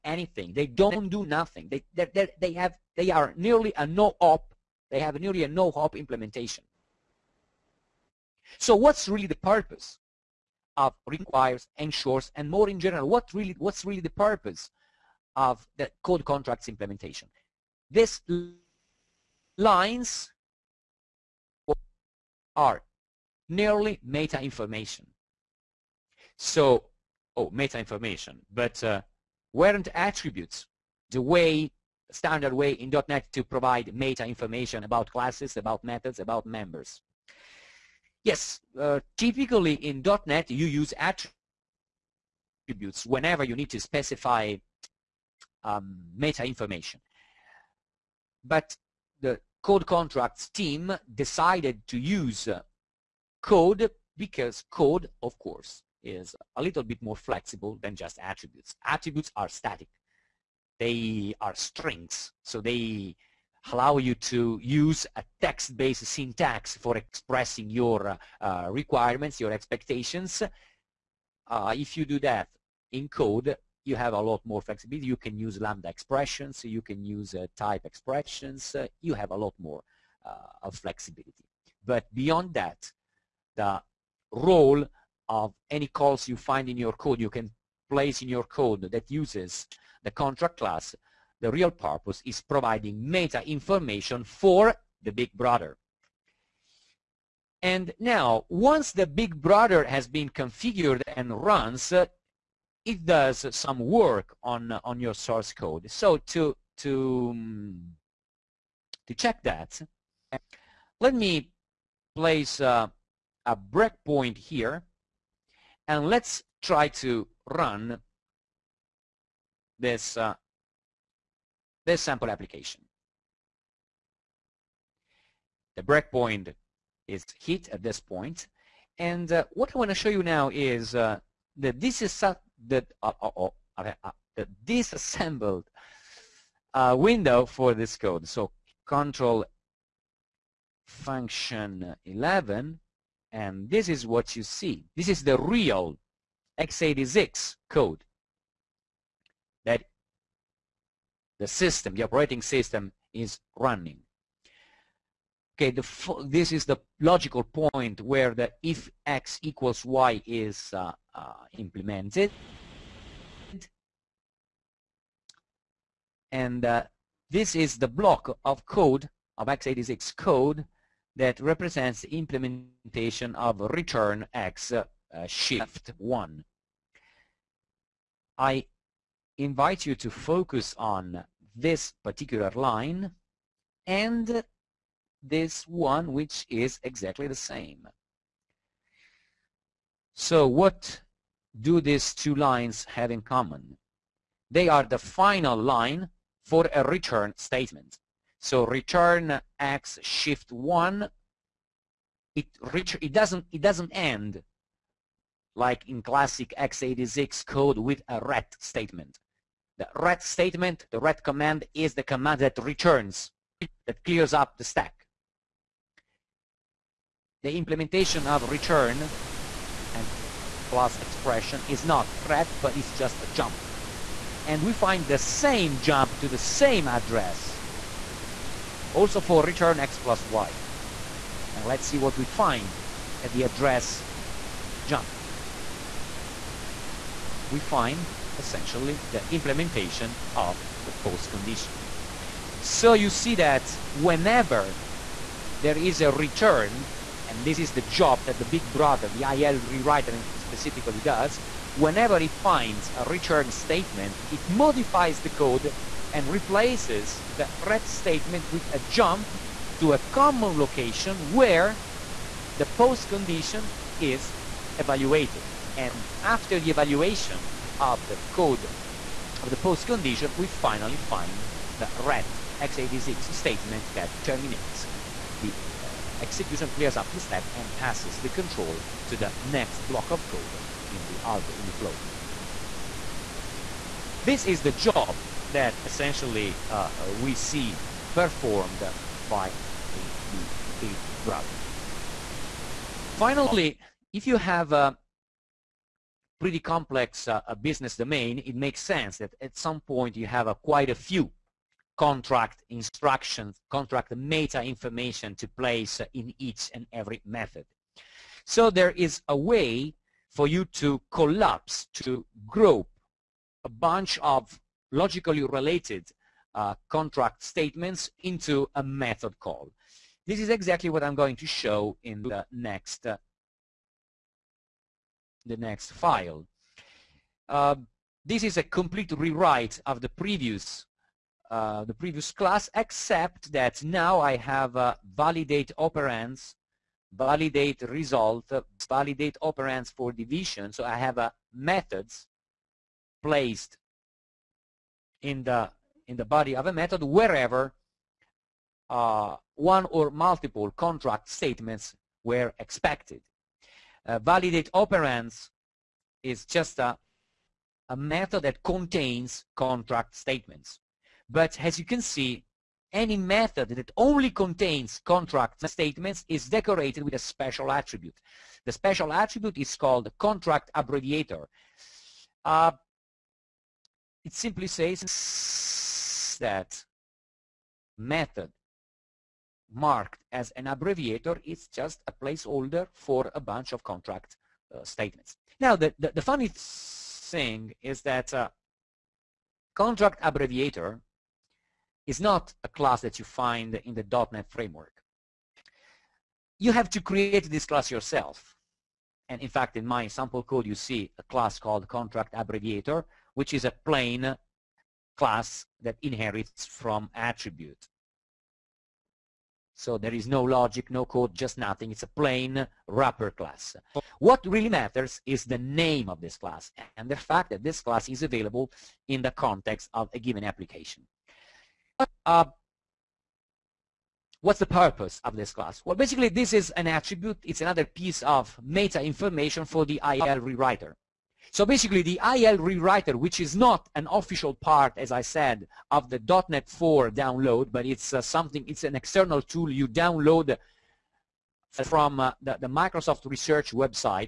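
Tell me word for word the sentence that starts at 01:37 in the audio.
And now, once the big brother has been configured and runs, uh, it does some work on, uh, on your source code.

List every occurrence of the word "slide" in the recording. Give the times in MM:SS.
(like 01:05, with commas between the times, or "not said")
not said.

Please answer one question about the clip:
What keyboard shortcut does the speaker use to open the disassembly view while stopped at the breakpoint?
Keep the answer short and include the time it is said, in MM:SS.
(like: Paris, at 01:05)
Control function 11, at 02:18.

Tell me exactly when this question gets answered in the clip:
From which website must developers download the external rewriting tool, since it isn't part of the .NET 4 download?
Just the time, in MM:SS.
07:22.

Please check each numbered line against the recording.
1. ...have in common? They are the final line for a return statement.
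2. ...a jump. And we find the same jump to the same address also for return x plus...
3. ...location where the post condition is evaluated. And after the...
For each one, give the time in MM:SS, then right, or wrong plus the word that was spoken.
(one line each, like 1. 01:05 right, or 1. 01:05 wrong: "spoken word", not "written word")
1. 03:12 right
2. 03:43 right
3. 04:20 right.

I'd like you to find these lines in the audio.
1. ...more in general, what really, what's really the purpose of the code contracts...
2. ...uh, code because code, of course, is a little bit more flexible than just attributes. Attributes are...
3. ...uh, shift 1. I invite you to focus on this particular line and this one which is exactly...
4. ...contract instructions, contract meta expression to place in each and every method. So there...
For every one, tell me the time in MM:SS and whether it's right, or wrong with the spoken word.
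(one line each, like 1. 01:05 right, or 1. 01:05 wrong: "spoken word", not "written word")
1. 00:12 right
2. 00:52 right
3. 02:54 right
4. 05:01 wrong: "information", not "expression".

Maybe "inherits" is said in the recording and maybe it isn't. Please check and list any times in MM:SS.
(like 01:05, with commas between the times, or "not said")
06:46.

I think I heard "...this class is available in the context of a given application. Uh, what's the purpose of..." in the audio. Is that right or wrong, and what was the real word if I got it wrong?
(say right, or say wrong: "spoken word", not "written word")
right.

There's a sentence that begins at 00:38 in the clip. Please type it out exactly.
Yes, uh, typically in .NET you use attributes whenever you need to specify um, meta information.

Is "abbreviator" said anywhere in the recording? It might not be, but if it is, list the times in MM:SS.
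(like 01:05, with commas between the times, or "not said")
06:10, 06:20, 06:30, 06:42.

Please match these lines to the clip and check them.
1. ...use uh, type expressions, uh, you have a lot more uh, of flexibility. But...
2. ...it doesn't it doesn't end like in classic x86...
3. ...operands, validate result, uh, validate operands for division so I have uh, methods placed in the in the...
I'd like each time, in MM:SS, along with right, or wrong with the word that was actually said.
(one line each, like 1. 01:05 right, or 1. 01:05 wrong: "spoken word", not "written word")
1. 01:17 right
2. 03:23 right
3. 05:35 right.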